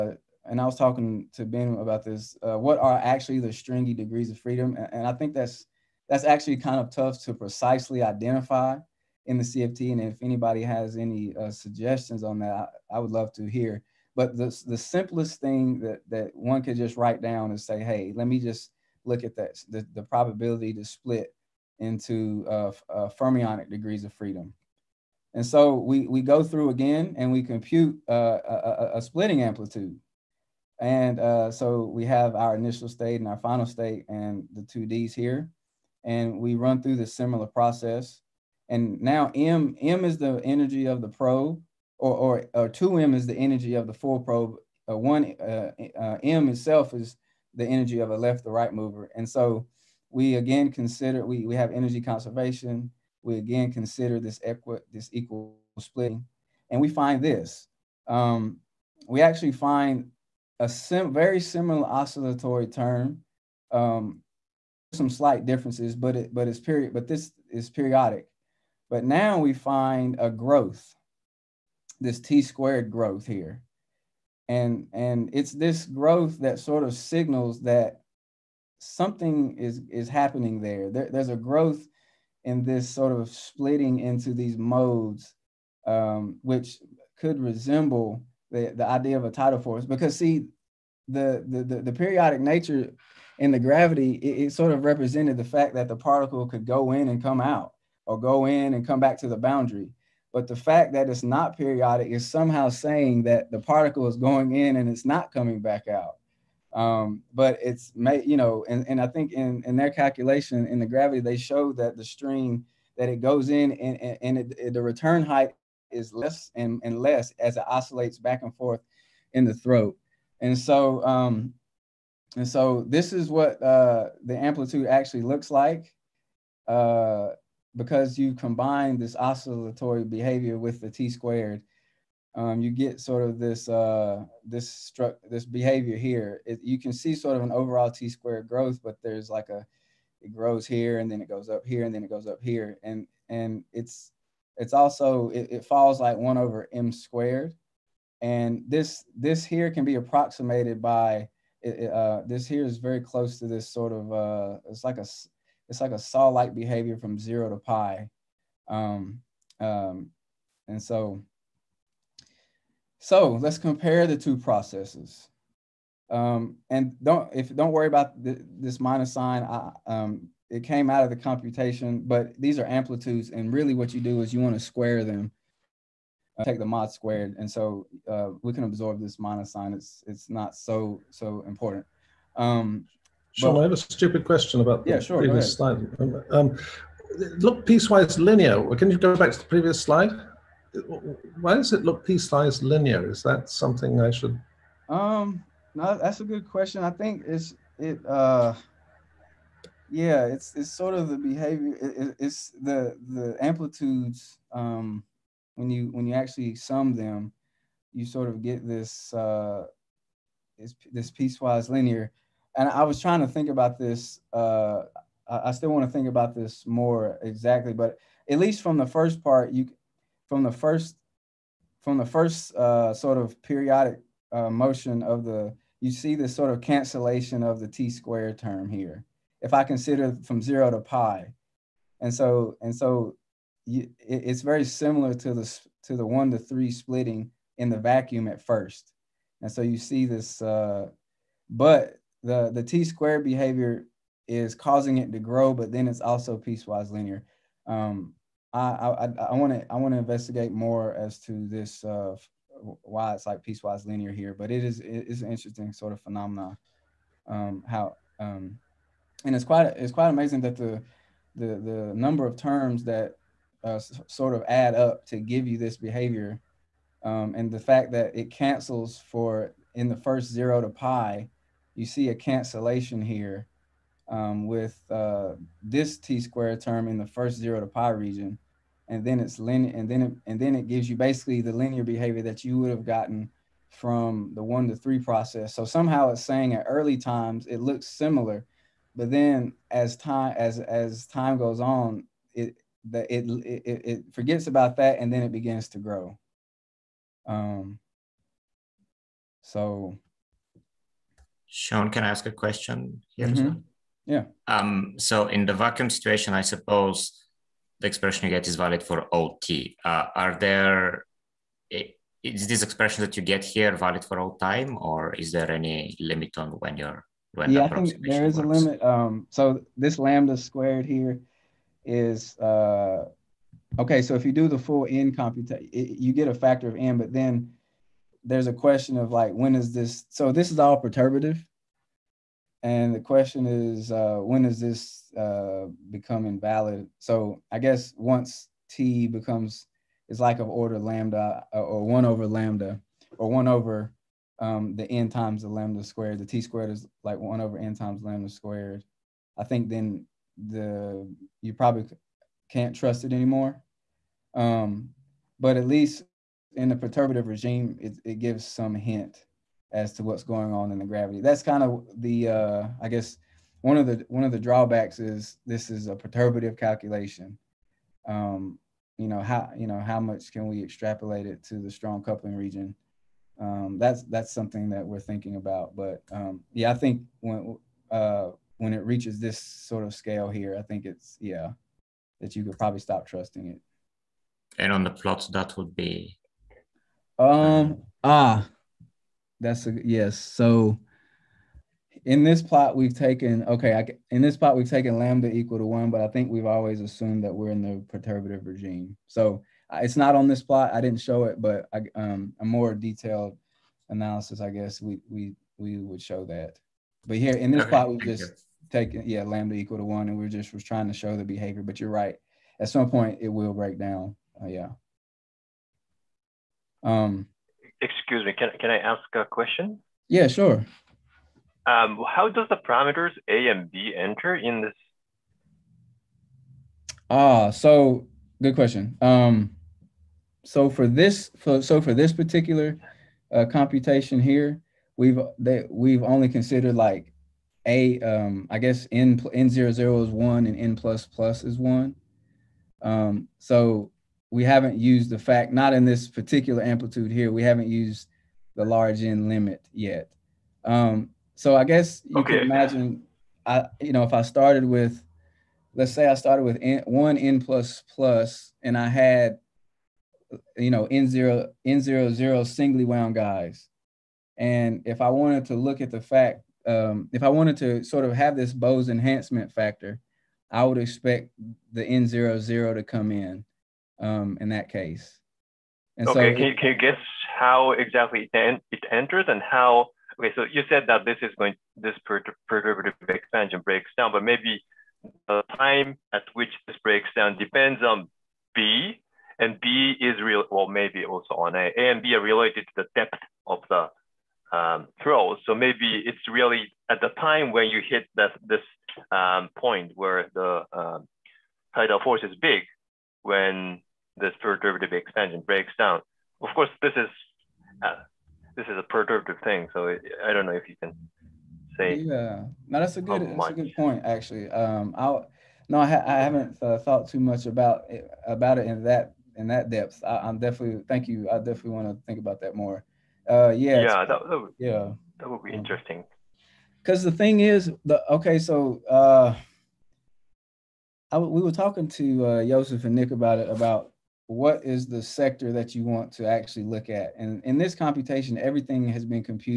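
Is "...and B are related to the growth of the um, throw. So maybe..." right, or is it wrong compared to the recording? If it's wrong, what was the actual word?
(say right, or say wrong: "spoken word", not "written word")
wrong: "depth", not "growth".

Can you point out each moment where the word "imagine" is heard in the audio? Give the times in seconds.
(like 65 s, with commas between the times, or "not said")
452 s.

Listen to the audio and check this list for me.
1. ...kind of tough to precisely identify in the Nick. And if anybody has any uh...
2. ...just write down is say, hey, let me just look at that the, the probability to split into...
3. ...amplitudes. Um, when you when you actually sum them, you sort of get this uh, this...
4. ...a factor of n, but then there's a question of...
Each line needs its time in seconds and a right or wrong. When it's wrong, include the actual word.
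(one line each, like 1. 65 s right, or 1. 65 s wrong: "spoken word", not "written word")
1. 6 s wrong: "CFT", not "Nick"
2. 16 s right
3. 203 s right
4. 326 s right.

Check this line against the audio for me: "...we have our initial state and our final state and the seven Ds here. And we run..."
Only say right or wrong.
wrong.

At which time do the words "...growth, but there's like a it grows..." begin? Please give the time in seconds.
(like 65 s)
138 s.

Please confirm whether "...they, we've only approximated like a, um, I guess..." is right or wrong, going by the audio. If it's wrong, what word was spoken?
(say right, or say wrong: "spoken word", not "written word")
wrong: "considered", not "approximated".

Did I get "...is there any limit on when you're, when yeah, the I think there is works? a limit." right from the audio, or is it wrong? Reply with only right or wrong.
right.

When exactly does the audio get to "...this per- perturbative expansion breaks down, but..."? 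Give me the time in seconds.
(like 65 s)
481 s.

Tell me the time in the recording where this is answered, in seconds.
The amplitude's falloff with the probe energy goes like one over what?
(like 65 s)
146 s.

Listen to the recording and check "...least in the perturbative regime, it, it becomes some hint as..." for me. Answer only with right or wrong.
wrong.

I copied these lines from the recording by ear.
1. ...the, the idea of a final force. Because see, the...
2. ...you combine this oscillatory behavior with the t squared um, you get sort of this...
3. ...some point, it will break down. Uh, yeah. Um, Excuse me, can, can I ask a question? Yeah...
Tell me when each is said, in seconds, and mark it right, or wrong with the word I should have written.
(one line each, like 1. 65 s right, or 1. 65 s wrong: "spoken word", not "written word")
1. 88 s wrong: "tidal", not "final"
2. 128 s right
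3. 412 s right.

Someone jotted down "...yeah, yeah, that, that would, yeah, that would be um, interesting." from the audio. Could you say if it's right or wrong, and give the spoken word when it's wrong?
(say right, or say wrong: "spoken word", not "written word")
right.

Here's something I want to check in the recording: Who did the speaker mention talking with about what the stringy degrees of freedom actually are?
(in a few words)
Ben.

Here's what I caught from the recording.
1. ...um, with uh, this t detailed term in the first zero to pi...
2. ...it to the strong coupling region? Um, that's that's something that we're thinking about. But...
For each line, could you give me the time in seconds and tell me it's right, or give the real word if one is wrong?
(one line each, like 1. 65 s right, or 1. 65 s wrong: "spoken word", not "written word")
1. 274 s wrong: "squared", not "detailed"
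2. 371 s right.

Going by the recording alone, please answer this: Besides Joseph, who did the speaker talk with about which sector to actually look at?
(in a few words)
Nick.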